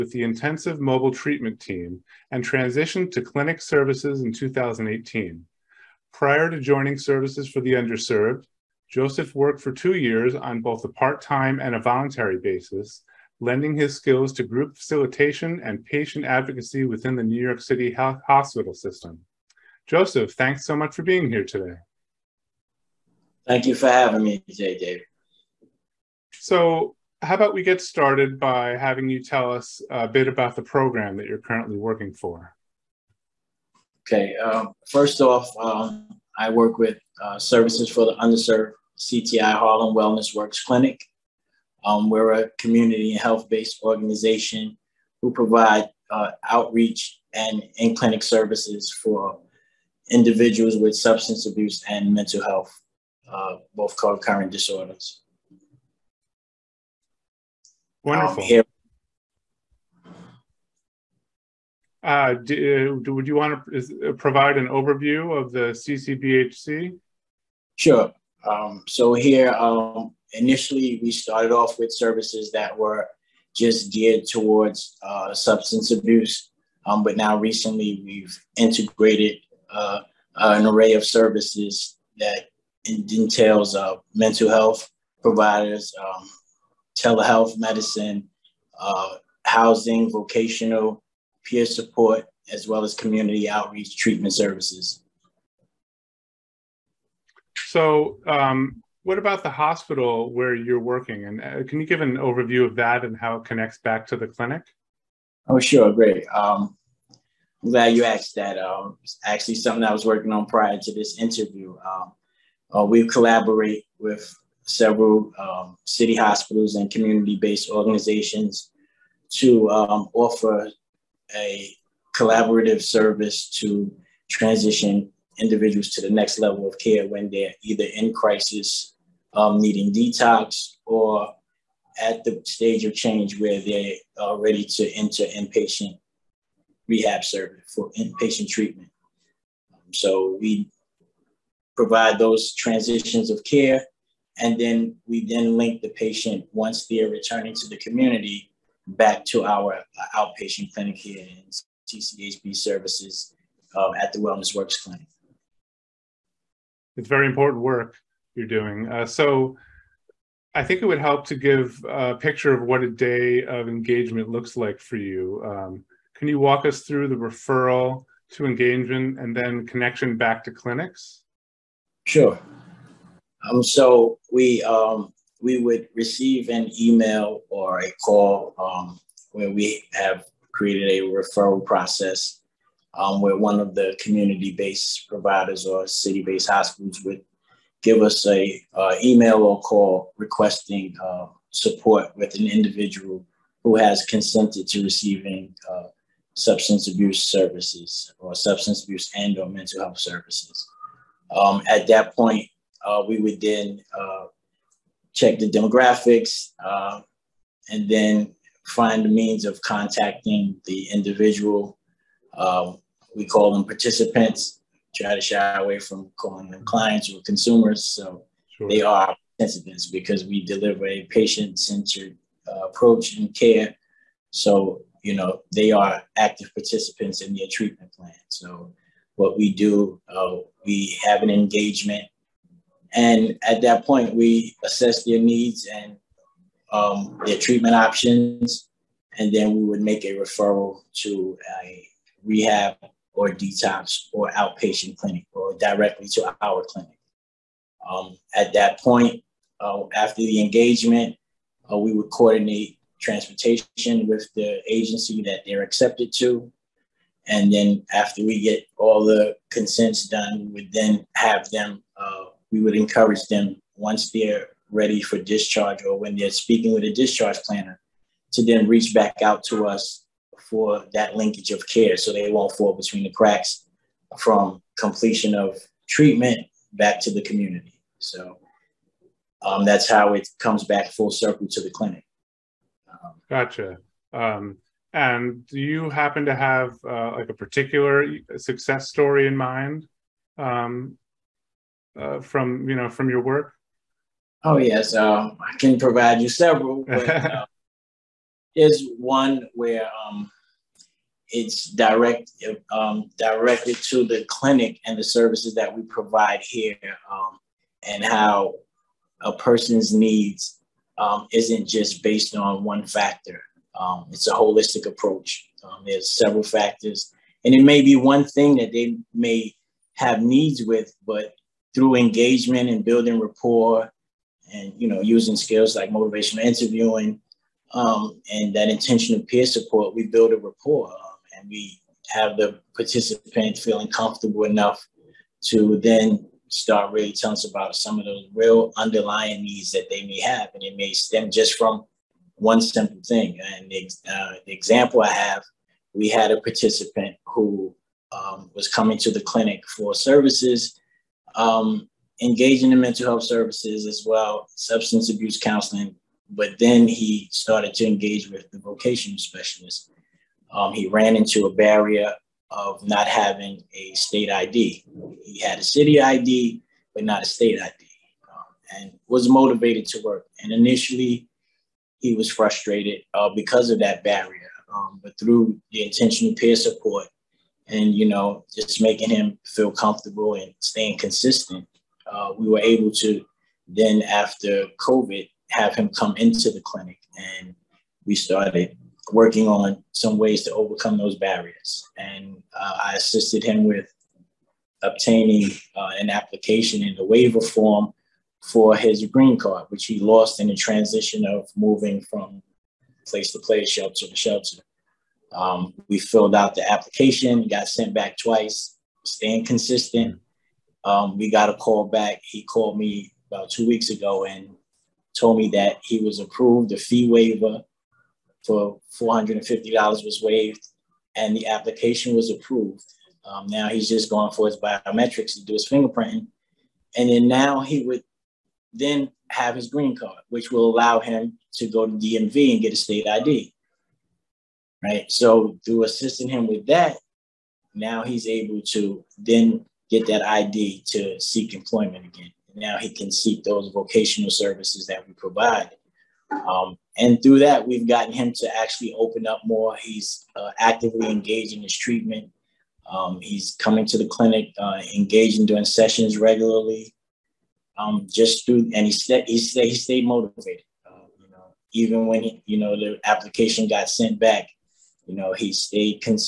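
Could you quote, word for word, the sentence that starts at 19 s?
Joseph, thanks so much for being here today.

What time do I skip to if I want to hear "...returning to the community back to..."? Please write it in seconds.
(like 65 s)
147 s.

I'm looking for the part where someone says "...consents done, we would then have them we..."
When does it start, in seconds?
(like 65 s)
259 s.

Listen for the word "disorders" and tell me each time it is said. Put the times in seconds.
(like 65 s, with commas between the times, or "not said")
54 s.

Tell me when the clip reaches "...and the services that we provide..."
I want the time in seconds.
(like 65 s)
304 s.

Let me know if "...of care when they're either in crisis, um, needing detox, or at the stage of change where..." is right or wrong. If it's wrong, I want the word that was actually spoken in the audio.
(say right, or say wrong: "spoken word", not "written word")
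right.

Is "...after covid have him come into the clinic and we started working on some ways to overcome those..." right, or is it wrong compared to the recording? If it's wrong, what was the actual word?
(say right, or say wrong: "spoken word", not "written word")
right.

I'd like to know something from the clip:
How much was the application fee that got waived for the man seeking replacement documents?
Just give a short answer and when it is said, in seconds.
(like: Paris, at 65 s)
$450, at 418 s.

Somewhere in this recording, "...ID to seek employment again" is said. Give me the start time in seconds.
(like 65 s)
440 s.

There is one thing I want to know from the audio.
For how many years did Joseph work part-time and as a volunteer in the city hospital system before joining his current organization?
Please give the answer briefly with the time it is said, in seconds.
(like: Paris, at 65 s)
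2, at 9 s.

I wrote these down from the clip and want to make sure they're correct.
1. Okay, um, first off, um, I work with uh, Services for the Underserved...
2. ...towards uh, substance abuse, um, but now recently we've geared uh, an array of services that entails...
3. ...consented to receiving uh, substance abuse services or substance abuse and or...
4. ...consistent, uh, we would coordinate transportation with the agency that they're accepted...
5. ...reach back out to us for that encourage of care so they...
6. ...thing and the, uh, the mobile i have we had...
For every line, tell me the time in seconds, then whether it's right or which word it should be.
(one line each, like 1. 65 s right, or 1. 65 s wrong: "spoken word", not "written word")
1. 34 s right
2. 74 s wrong: "integrated", not "geared"
3. 194 s right
4. 250 s wrong: "engagement", not "consistent"
5. 268 s wrong: "linkage", not "encourage"
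6. 343 s wrong: "example", not "mobile".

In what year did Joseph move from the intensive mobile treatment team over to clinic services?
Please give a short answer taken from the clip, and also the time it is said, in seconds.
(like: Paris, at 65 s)
2018, at 4 s.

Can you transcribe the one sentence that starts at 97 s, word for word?
So, um, what about the hospital where you're working?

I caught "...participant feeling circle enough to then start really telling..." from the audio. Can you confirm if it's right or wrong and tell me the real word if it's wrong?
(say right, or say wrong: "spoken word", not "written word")
wrong: "comfortable", not "circle".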